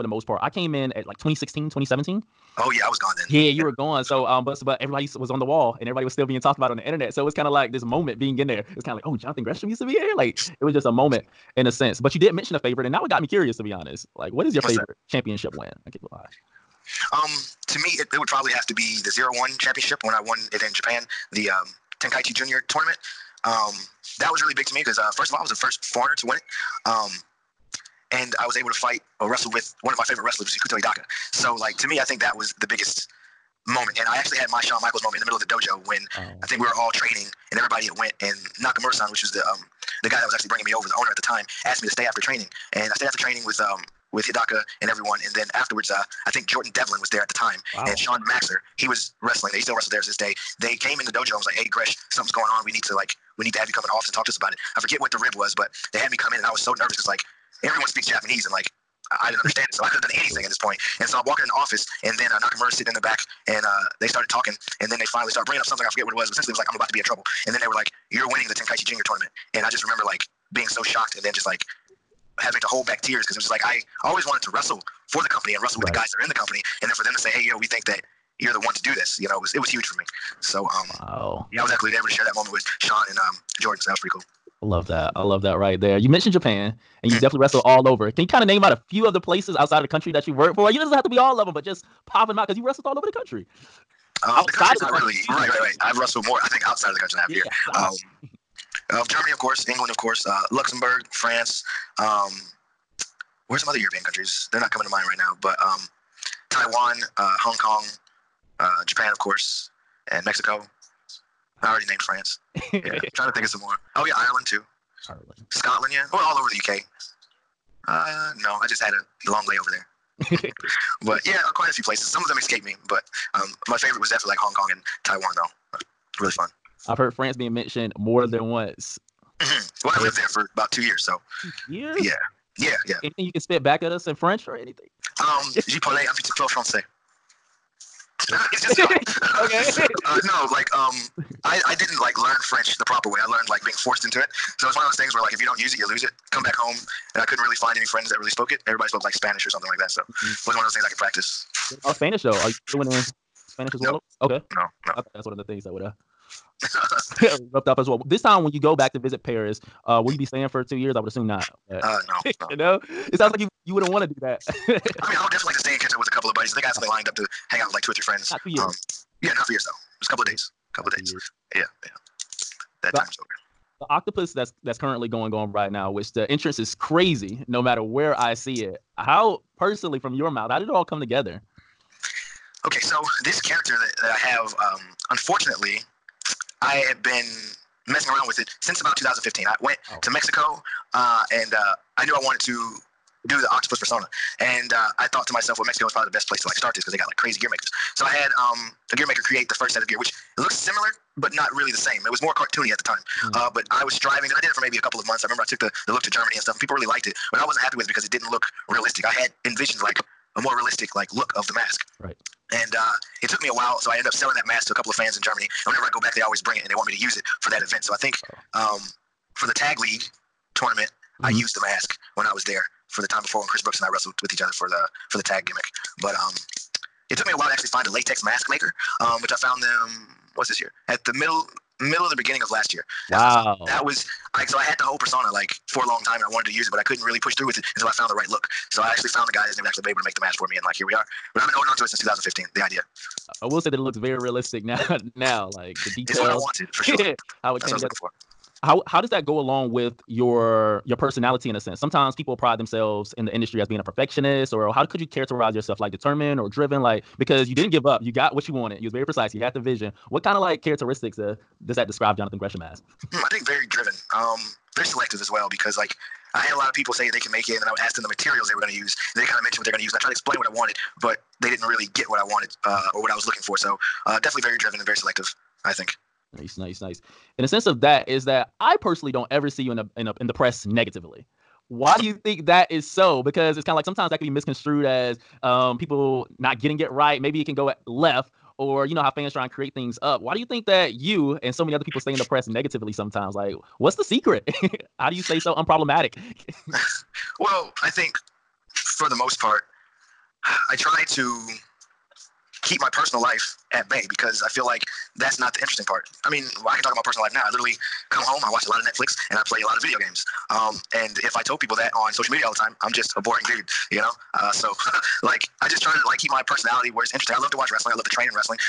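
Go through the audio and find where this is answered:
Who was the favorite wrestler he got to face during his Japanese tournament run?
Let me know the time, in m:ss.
0:30.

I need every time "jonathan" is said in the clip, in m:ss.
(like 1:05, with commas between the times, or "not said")
0:09, 4:22.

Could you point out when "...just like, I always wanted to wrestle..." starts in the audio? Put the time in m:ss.
1:13.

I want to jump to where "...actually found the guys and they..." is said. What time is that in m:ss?
3:58.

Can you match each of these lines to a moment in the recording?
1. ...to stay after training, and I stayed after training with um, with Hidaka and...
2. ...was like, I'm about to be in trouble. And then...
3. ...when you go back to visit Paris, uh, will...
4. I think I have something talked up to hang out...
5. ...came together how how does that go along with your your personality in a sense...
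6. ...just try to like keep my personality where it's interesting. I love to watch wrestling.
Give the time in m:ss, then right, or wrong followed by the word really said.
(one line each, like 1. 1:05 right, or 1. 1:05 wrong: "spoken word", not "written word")
1. 0:41 right
2. 1:06 right
3. 2:38 right
4. 2:46 wrong: "lined", not "talked"
5. 4:07 right
6. 5:15 right.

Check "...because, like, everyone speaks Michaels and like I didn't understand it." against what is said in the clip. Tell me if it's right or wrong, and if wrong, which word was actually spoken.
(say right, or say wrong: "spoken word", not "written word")
wrong: "Japanese", not "Michaels".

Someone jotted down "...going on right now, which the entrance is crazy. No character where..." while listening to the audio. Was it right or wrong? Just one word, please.
wrong.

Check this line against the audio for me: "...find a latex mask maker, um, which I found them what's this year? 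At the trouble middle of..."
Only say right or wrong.
wrong.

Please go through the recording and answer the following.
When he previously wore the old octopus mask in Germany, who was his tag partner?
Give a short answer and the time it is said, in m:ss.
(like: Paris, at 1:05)
Chris Brooks, at 3:43.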